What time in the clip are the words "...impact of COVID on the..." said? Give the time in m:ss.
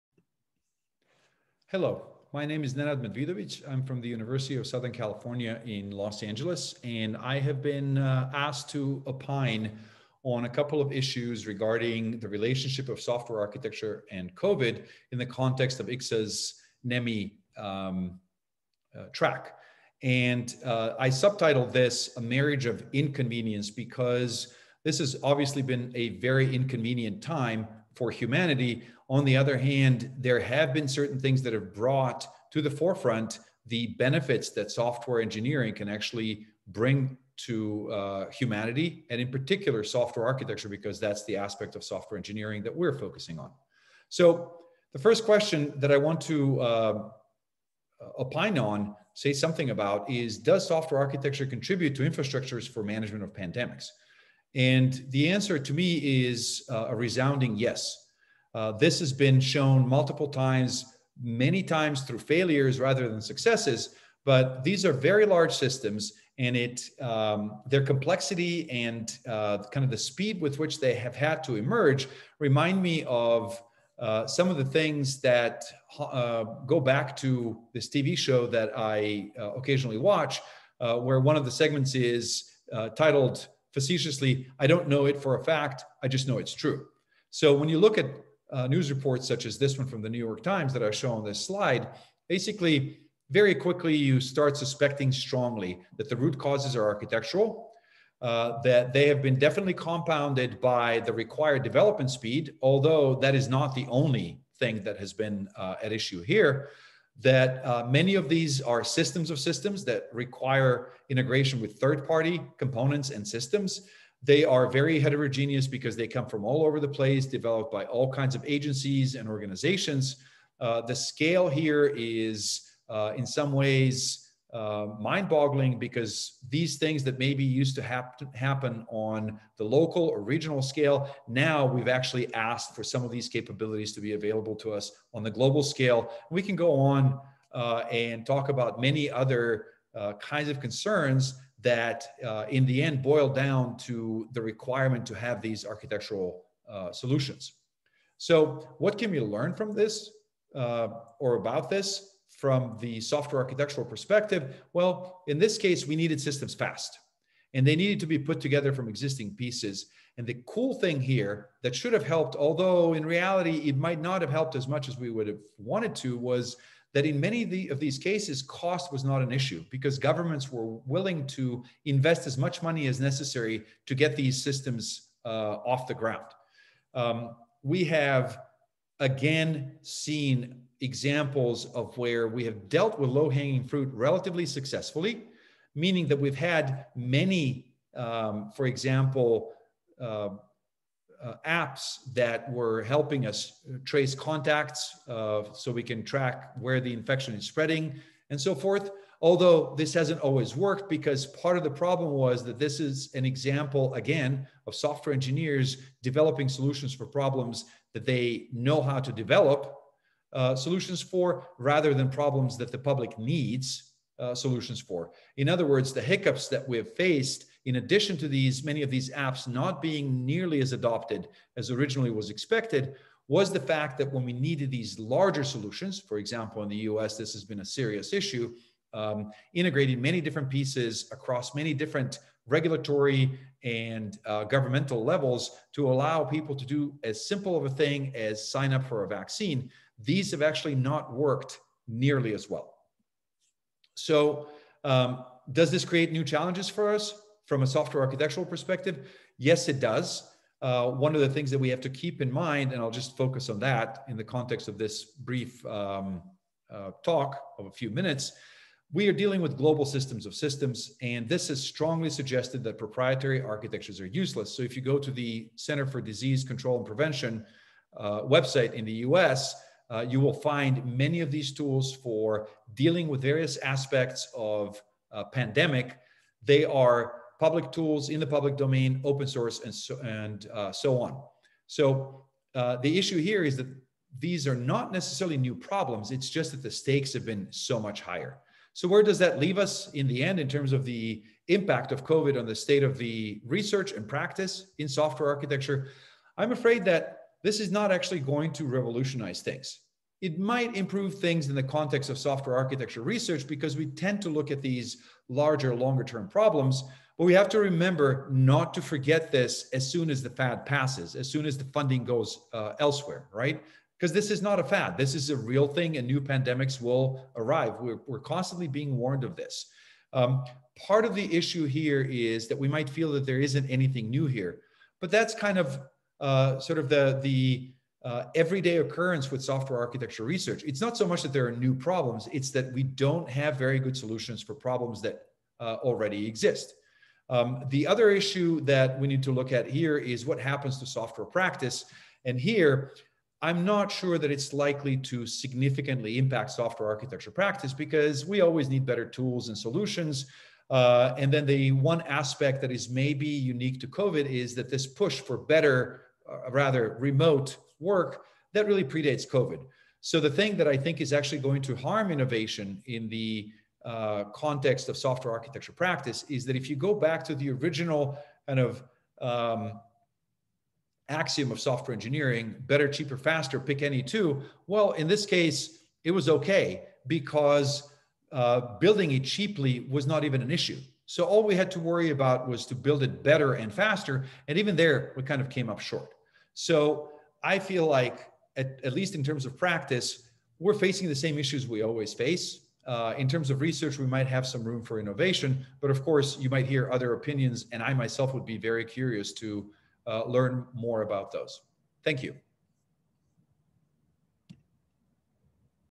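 4:51.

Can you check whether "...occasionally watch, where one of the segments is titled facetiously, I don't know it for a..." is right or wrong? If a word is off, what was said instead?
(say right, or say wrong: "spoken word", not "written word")
right.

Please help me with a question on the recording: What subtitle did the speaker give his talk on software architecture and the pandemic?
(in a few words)
A Marriage of Inconvenience.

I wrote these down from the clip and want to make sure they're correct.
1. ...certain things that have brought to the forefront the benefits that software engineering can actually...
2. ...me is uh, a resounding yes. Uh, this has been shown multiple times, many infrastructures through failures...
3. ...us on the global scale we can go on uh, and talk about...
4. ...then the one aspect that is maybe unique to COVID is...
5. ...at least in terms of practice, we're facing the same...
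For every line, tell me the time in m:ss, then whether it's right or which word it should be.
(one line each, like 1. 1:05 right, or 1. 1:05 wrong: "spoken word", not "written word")
1. 0:30 right
2. 0:55 wrong: "times", not "infrastructures"
3. 2:14 right
4. 5:51 right
5. 6:28 right.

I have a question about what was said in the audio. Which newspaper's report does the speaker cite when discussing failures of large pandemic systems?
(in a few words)
New York Times.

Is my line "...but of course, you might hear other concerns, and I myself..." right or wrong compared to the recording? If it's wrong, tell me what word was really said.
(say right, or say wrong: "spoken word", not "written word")
wrong: "opinions", not "concerns".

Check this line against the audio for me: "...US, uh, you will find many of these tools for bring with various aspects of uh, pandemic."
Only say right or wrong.
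wrong.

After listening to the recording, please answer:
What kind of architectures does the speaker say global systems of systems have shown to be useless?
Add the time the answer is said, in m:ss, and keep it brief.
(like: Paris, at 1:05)
Proprietary architectures, at 4:22.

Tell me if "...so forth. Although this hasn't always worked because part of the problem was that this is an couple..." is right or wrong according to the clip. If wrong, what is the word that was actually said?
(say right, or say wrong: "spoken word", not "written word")
wrong: "example", not "couple".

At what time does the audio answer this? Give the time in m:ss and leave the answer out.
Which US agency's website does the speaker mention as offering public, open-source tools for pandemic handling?
4:25.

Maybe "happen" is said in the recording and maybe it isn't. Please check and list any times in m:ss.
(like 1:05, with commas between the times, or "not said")
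2:08, 5:40.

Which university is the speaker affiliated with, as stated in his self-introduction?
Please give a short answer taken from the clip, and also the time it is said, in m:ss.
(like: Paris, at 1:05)
University of Southern California, at 0:04.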